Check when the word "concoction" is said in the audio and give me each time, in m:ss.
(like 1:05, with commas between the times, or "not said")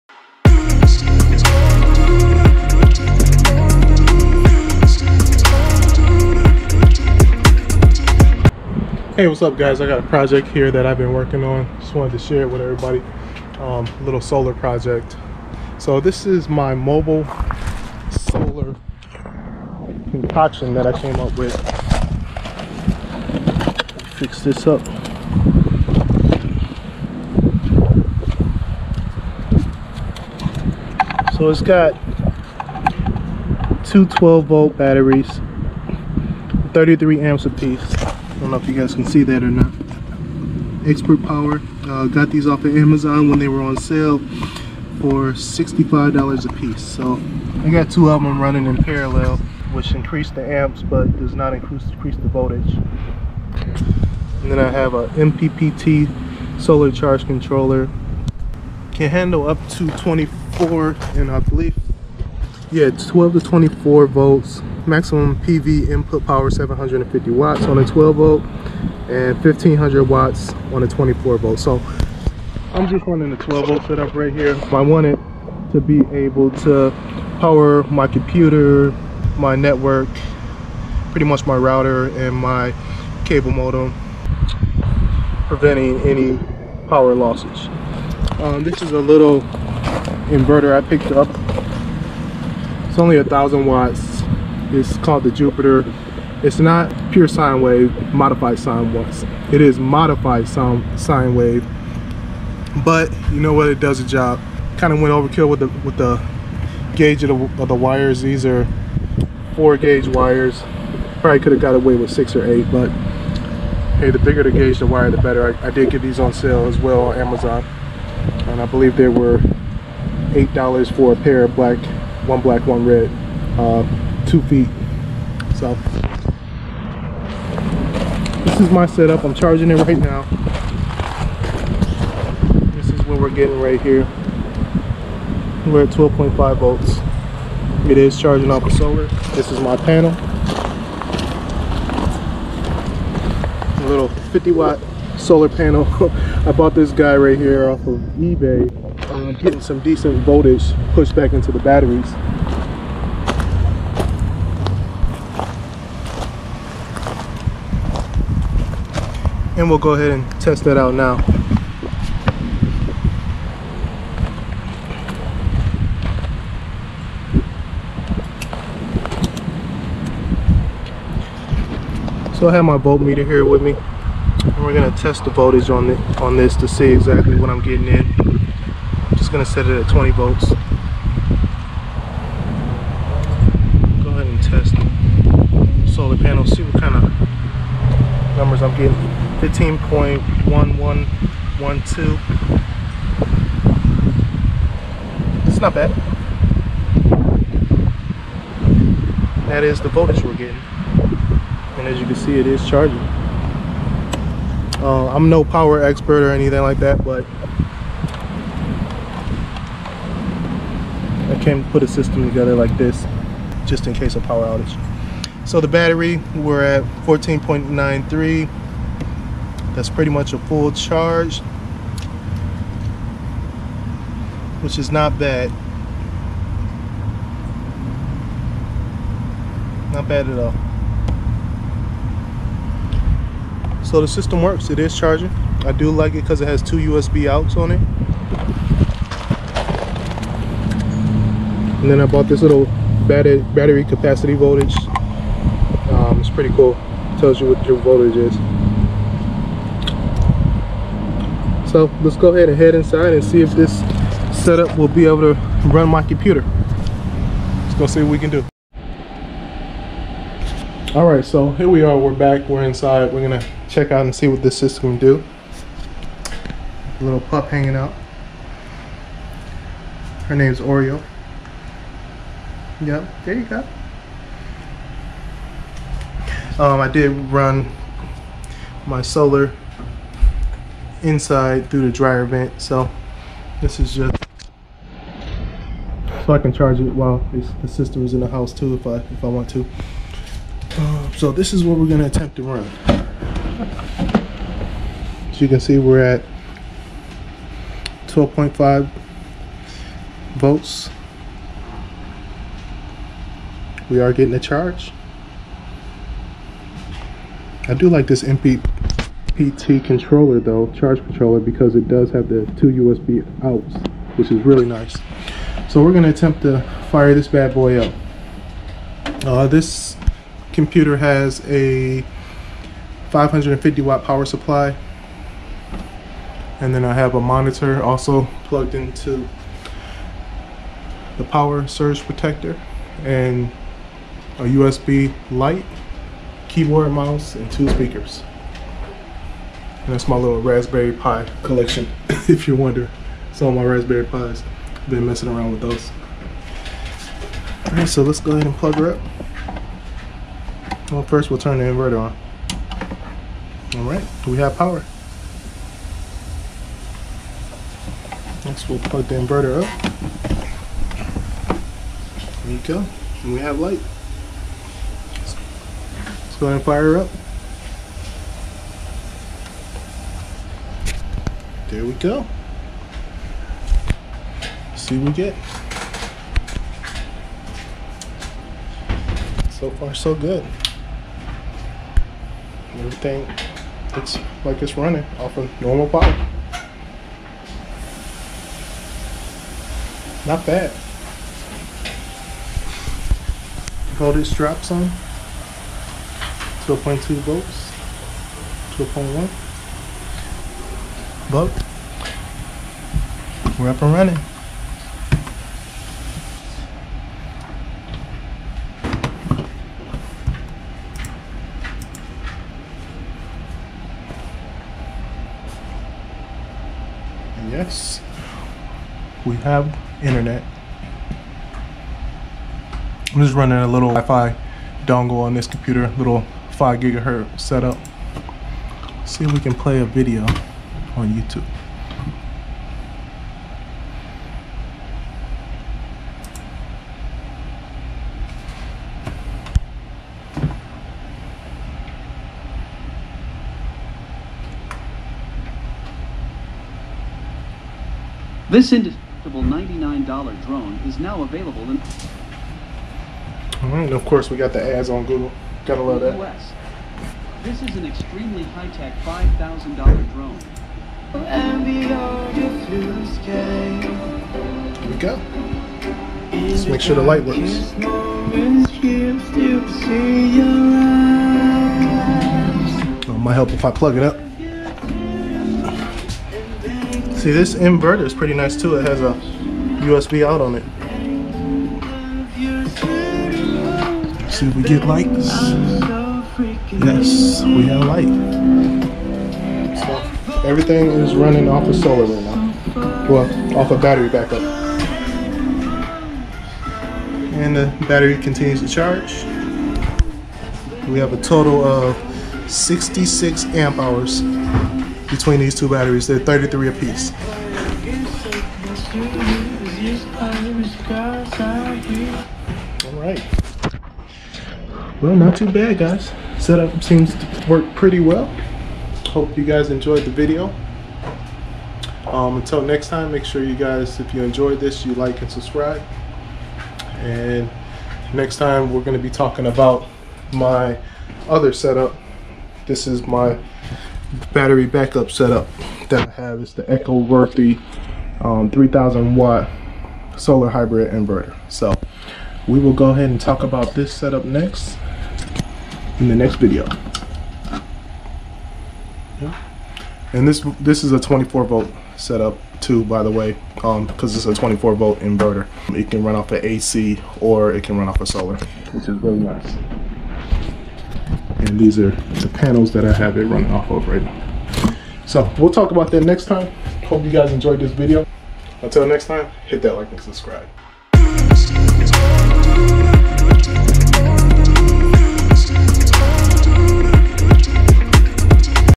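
0:20.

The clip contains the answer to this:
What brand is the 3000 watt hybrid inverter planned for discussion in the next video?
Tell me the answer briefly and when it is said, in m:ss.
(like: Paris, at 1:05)
Eco-Worthy, at 8:56.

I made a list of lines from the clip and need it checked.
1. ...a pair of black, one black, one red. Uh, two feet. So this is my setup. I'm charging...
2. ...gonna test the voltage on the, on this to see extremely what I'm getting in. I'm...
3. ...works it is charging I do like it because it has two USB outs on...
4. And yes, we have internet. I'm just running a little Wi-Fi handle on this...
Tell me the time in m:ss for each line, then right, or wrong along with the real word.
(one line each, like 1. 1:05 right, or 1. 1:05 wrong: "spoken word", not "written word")
1. 2:01 right
2. 2:54 wrong: "exactly", not "extremely"
3. 3:54 right
4. 6:57 wrong: "dongle", not "handle".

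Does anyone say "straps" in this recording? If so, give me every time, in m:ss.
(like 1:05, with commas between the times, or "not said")
6:34.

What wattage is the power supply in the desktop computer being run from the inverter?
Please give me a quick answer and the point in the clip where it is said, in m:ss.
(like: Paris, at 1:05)
550 watt, at 5:23.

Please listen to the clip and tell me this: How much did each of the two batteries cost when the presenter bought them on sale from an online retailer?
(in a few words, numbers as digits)
$65.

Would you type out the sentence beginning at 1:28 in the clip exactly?
Um, this is a little inverter I picked up.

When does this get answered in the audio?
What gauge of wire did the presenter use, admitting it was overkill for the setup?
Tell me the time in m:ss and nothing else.
1:49.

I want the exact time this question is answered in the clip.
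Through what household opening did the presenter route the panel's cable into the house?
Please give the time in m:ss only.
4:41.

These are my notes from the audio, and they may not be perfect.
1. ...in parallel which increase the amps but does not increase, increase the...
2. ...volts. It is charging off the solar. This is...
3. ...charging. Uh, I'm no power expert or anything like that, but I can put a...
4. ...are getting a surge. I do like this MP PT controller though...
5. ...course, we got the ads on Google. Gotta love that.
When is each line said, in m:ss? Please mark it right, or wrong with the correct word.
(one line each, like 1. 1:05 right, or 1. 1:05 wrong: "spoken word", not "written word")
1. 0:48 right
2. 2:16 right
3. 3:22 right
4. 5:03 wrong: "charge", not "surge"
5. 7:34 right.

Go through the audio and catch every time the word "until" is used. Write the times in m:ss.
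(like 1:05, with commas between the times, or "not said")
8:42, 9:28.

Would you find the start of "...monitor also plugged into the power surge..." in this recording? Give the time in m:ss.
5:27.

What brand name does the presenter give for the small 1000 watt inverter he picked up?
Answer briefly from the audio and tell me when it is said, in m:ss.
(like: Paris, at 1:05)
Jupiter, at 1:35.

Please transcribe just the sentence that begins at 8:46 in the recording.
And next time, we're going to be talking about my other setup.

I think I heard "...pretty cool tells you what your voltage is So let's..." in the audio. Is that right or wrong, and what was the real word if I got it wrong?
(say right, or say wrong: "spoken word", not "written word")
right.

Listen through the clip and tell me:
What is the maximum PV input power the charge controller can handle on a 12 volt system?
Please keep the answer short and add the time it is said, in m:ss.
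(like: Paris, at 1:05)
750 watts, at 1:06.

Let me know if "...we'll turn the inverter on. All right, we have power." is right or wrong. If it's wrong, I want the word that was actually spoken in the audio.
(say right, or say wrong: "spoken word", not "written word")
right.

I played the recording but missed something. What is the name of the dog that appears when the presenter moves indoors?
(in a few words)
Oreo.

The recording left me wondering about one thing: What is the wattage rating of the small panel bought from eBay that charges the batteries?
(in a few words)
50 watt.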